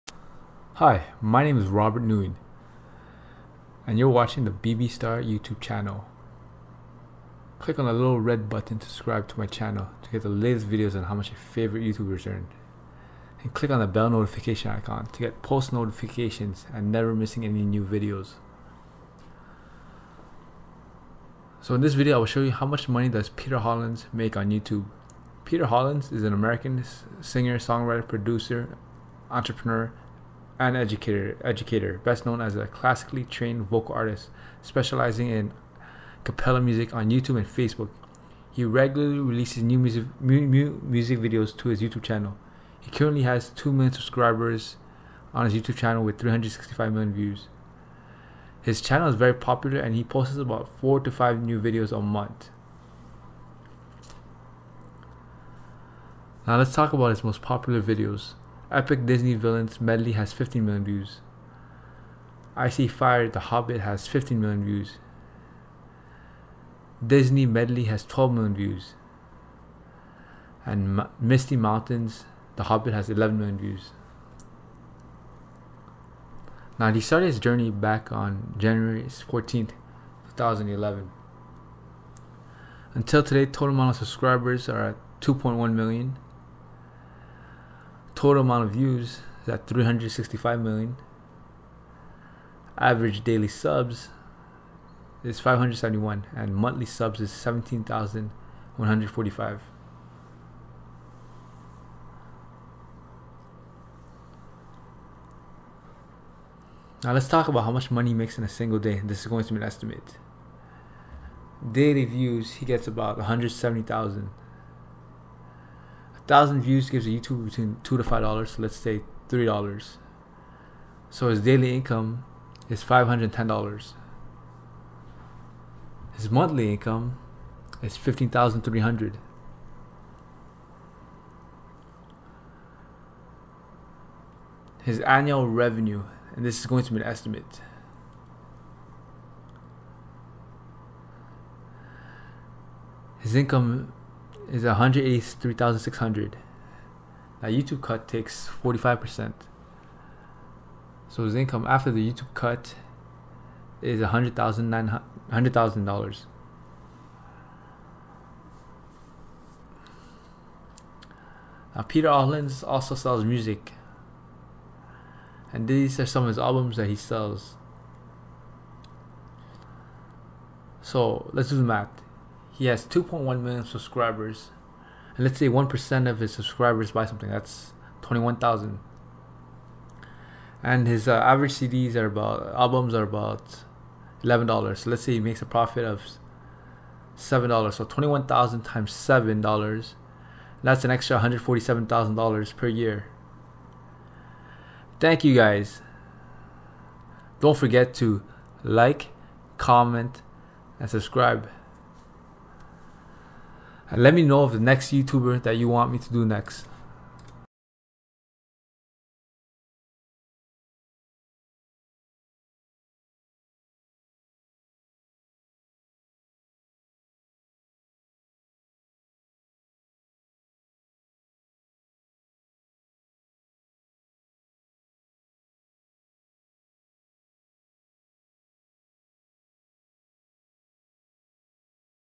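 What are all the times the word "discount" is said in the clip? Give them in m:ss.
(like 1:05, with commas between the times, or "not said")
not said.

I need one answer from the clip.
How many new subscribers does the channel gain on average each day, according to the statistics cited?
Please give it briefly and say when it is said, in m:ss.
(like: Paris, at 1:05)
571, at 1:35.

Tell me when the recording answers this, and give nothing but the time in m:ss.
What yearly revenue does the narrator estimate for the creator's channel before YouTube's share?
2:24.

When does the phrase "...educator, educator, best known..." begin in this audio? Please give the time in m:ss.
0:30.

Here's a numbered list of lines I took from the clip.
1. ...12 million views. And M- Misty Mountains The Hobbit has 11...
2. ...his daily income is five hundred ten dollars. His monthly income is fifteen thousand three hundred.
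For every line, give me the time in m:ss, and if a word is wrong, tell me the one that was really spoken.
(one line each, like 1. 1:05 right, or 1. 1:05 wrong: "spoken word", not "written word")
1. 1:08 right
2. 2:01 right.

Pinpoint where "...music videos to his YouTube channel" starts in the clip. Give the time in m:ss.
0:40.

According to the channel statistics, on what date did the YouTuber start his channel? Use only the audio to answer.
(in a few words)
January 14, 2011.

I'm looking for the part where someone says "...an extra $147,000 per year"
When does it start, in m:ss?
3:10.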